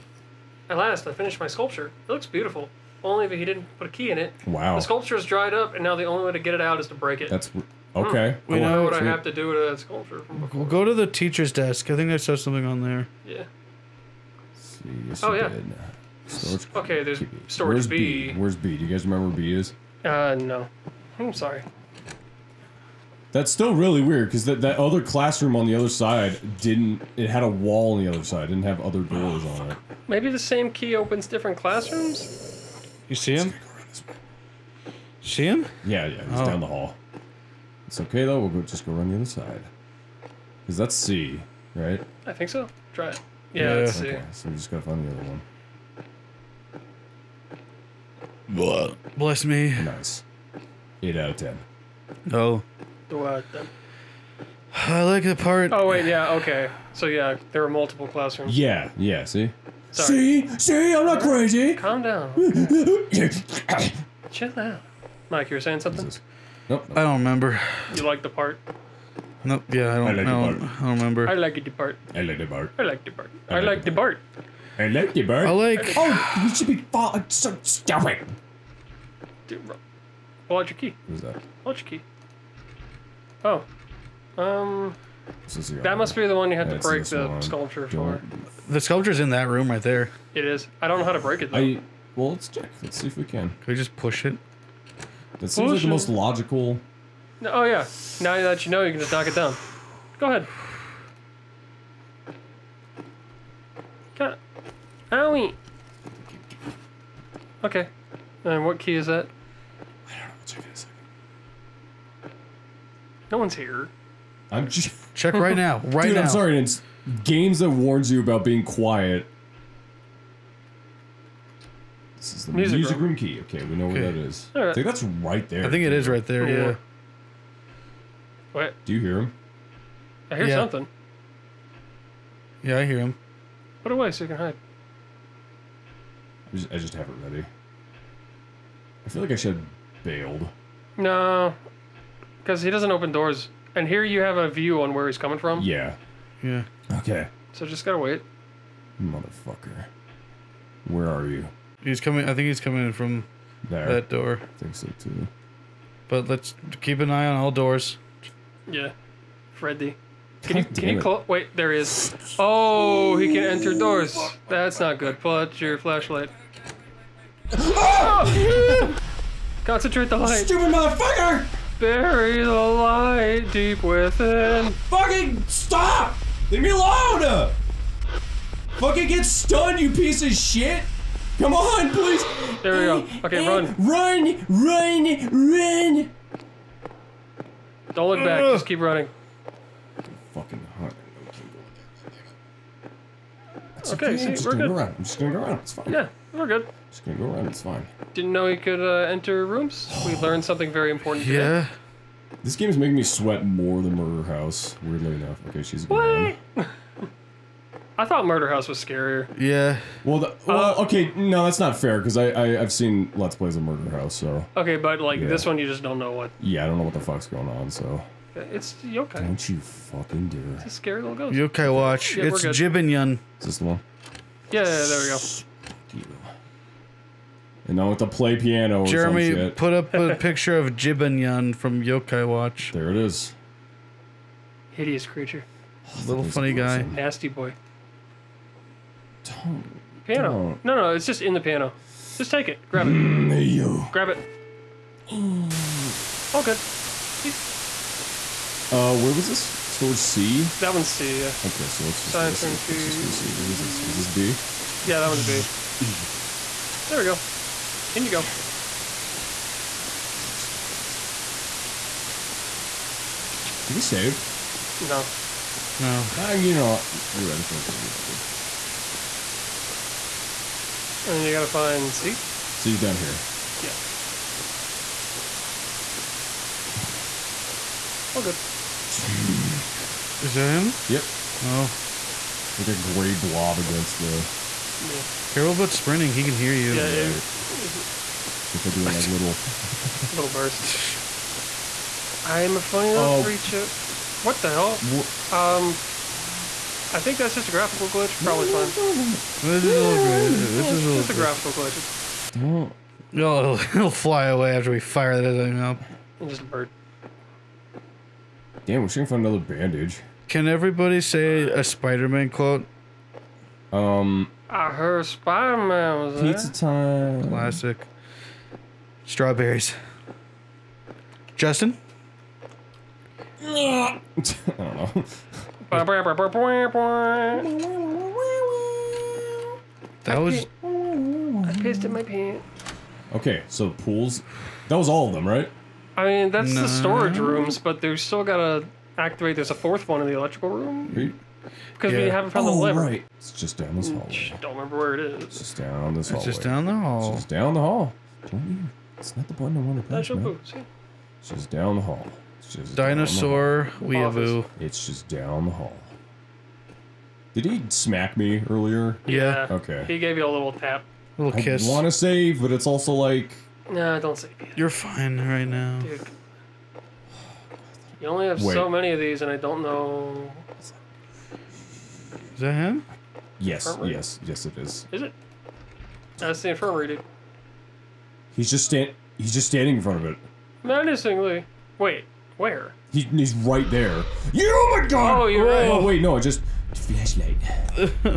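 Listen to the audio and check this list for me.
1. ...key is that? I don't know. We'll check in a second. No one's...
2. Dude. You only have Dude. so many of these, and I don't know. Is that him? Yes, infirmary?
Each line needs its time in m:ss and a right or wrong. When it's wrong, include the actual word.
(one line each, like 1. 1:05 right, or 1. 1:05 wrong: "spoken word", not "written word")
1. 1:48 right
2. 6:05 wrong: "Wait", not "Dude".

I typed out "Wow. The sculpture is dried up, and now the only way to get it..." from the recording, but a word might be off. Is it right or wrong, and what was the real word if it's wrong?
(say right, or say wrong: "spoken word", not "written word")
right.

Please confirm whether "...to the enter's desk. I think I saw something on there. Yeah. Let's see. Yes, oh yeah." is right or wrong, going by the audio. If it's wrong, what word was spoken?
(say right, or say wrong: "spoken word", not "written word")
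wrong: "teacher", not "enter".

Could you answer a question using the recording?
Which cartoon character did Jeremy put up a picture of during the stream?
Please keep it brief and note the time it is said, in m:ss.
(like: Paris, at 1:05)
Jibanyan, at 3:50.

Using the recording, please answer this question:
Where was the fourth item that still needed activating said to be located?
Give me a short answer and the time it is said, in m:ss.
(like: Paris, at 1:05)
Electrical room, at 5:40.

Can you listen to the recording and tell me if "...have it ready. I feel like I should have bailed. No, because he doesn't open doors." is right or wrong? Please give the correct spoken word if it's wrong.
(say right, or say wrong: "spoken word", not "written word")
right.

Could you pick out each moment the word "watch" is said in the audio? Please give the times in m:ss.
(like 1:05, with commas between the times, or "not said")
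3:41, 3:52.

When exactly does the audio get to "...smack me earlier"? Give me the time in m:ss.
5:57.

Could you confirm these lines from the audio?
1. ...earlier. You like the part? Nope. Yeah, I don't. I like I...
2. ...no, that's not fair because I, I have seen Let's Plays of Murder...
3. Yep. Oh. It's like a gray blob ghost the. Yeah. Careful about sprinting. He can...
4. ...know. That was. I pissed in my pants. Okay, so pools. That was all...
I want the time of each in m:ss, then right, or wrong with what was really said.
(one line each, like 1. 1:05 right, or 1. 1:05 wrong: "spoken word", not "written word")
1. 1:07 wrong: "remember", not "earlier"
2. 3:31 right
3. 4:40 wrong: "against", not "ghost"
4. 5:24 right.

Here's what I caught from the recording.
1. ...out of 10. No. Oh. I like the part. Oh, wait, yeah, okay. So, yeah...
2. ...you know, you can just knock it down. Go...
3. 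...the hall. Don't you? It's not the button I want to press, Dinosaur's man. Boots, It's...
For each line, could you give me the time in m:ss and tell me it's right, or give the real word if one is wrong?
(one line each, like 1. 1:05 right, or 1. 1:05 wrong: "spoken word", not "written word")
1. 0:51 right
2. 1:38 right
3. 5:47 wrong: "That", not "Dinosaur".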